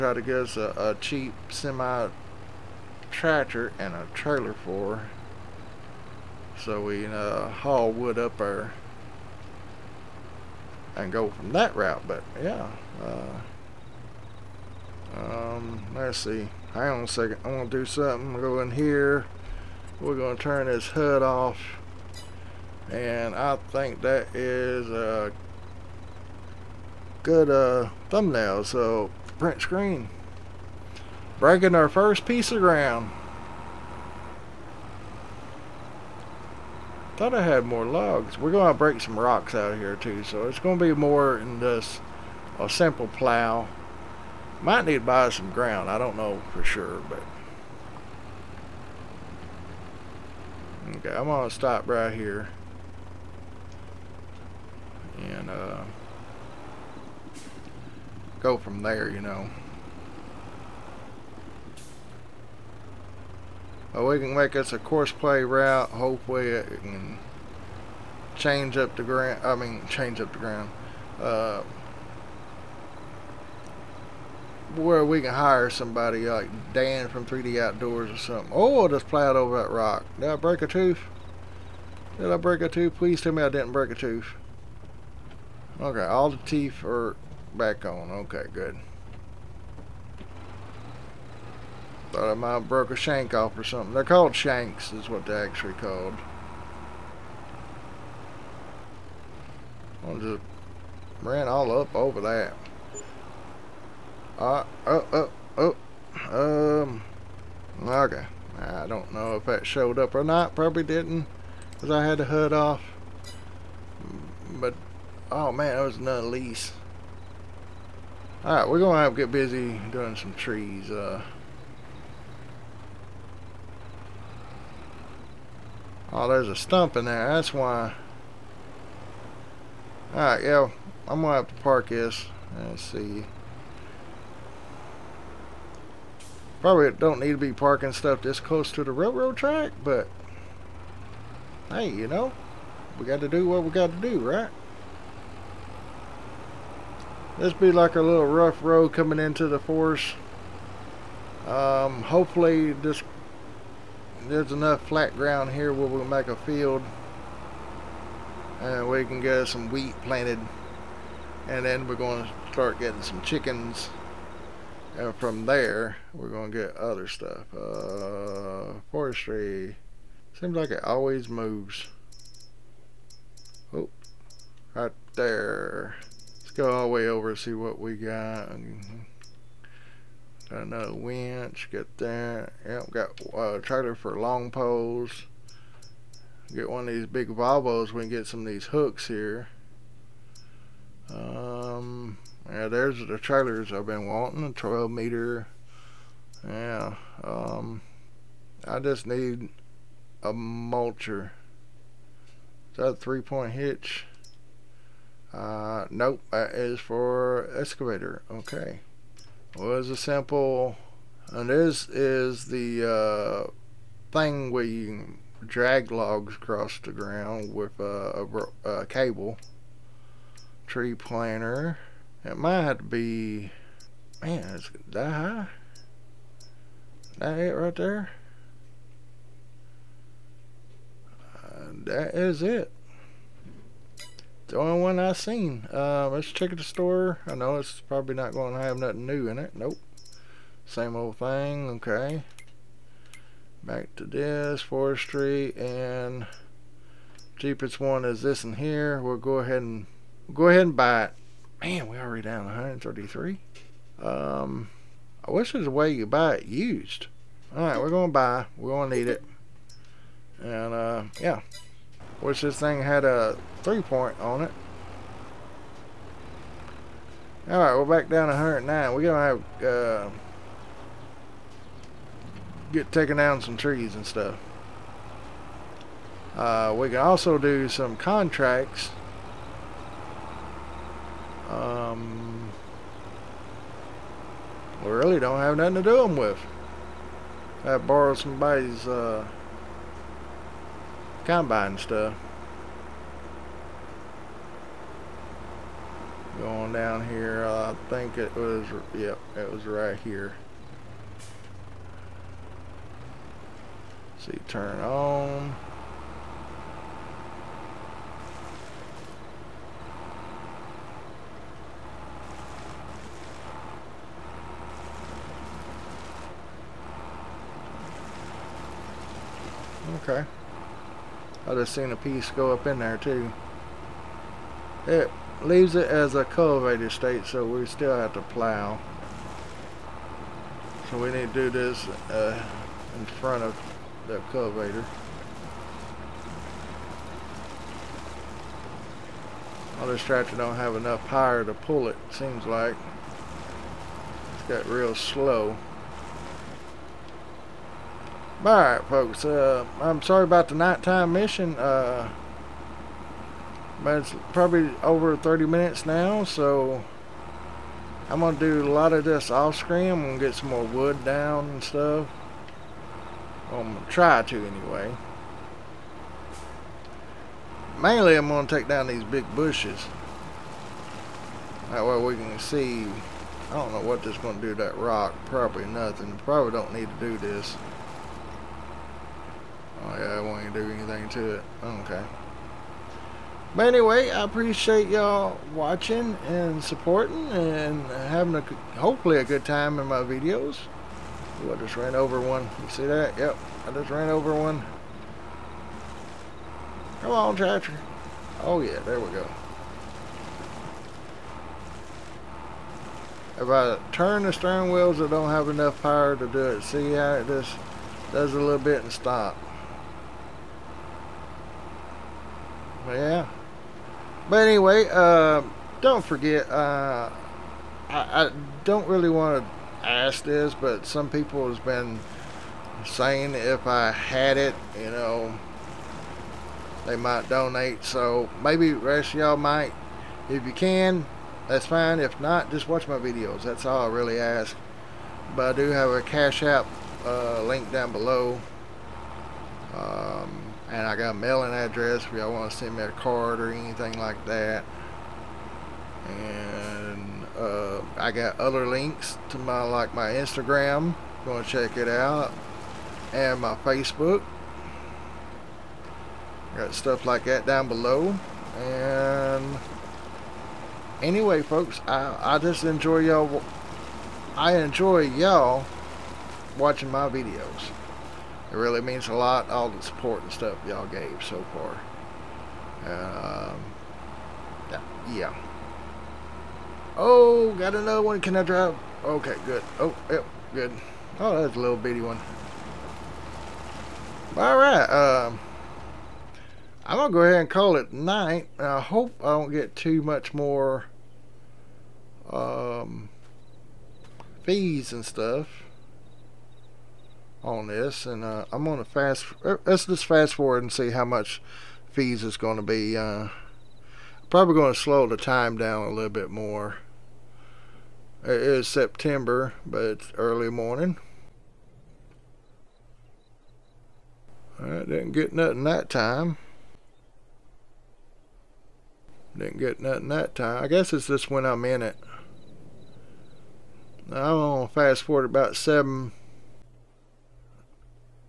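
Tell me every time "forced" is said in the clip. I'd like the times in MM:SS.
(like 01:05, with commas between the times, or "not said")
not said.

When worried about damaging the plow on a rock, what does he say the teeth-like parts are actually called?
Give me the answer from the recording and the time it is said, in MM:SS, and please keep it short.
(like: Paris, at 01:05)
shanks, at 01:34.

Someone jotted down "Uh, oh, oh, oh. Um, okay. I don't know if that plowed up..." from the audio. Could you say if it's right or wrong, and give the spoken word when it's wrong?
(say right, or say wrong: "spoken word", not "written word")
wrong: "showed", not "plowed".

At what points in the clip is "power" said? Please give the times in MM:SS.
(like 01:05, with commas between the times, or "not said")
05:41, 06:45.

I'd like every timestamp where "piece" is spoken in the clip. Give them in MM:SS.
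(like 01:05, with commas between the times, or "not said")
00:32, 05:21.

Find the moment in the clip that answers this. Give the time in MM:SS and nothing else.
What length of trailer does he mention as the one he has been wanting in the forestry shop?
03:14.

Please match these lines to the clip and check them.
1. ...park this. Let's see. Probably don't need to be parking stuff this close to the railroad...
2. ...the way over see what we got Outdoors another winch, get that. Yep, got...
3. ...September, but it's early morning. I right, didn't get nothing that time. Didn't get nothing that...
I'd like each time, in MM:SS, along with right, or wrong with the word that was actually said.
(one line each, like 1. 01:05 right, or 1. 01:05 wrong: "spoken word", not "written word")
1. 02:11 right
2. 02:56 wrong: "Got", not "Outdoors"
3. 08:28 right.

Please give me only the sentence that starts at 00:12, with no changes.
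But yeah, uh, um, let's see.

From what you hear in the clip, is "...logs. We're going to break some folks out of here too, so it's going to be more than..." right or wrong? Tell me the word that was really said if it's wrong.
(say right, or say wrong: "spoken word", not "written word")
wrong: "rocks", not "folks".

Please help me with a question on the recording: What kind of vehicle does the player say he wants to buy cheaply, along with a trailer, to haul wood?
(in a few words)
semi tractor.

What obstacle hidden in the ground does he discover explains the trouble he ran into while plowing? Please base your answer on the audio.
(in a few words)
a stump.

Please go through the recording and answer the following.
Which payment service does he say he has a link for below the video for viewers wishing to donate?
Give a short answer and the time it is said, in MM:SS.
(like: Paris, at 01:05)
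Cash App, at 07:16.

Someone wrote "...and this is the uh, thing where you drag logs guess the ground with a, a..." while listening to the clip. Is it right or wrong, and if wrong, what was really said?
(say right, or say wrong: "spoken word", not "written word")
wrong: "across", not "guess".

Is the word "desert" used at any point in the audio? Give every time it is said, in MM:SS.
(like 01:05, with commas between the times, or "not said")
not said.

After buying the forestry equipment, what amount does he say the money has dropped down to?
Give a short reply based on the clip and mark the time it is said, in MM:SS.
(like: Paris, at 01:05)
109, at 04:28.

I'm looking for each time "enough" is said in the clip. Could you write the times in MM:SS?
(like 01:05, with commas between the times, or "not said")
02:34, 05:40, 06:45.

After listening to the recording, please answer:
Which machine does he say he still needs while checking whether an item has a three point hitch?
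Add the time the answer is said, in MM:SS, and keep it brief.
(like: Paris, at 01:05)
a mulcher, at 03:20.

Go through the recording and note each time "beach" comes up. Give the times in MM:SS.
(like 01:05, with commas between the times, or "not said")
not said.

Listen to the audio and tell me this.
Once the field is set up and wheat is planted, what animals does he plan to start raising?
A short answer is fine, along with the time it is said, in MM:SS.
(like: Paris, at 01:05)
chickens, at 02:43.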